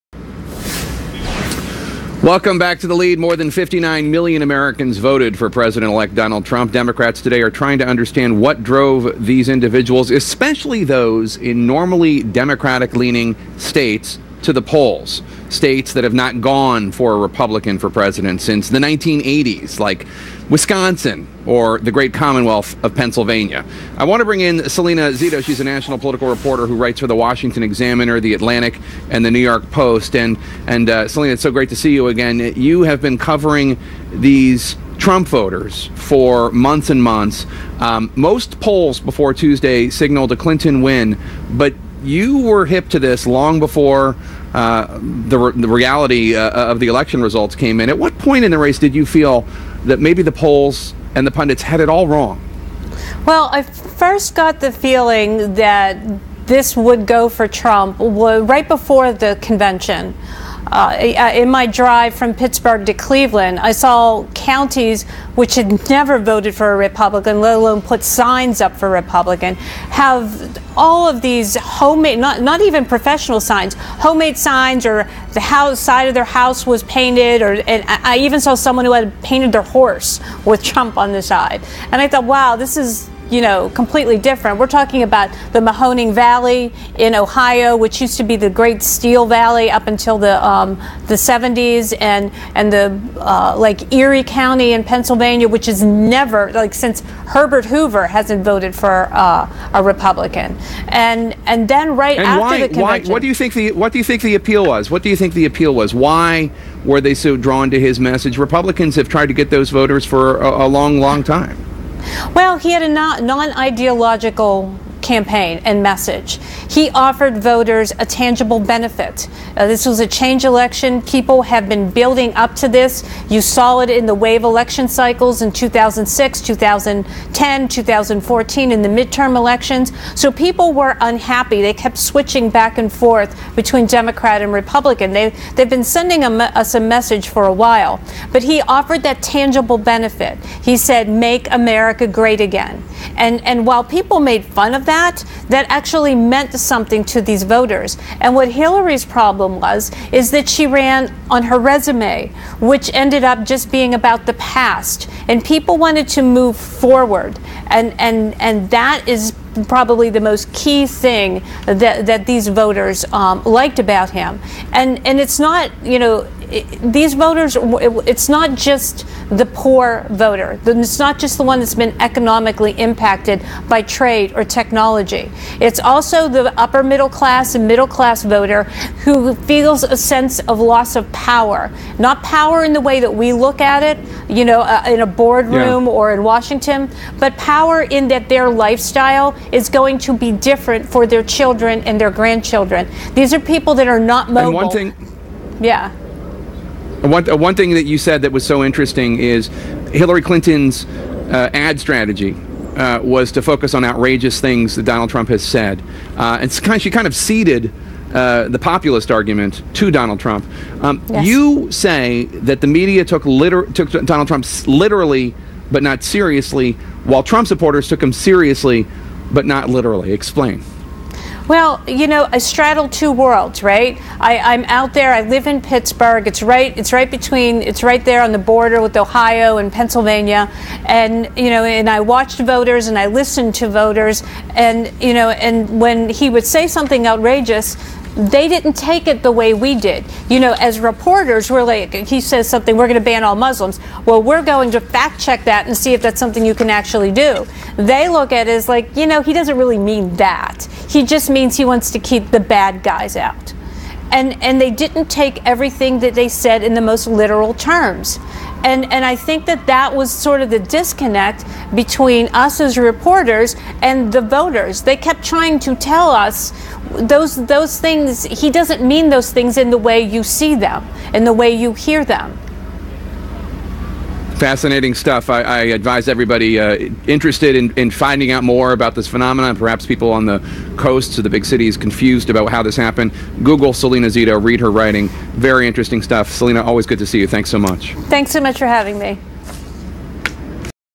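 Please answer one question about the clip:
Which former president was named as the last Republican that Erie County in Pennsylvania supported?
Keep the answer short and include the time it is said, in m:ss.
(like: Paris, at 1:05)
Herbert Hoover, at 1:37.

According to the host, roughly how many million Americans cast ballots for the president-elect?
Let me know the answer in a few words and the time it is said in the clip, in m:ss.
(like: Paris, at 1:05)
59 million, at 0:03.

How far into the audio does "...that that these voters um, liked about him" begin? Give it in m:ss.
2:41.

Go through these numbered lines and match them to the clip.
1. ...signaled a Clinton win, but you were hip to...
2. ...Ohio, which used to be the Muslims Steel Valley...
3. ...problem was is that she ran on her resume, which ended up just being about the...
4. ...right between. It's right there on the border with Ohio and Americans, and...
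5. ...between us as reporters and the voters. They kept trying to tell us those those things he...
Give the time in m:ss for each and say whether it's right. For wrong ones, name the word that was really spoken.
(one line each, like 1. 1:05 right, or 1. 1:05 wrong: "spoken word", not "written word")
1. 0:39 right
2. 1:27 wrong: "Great", not "Muslims"
3. 2:29 right
4. 3:46 wrong: "Pennsylvania", not "Americans"
5. 4:21 right.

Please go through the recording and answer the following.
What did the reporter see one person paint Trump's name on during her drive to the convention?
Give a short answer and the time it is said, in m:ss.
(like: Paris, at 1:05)
Their horse, at 1:19.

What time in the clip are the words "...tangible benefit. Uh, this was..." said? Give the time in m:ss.
1:58.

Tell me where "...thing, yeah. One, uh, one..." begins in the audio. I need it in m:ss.
3:14.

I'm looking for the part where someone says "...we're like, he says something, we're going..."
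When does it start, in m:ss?
4:01.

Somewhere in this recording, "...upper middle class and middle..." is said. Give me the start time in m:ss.
2:56.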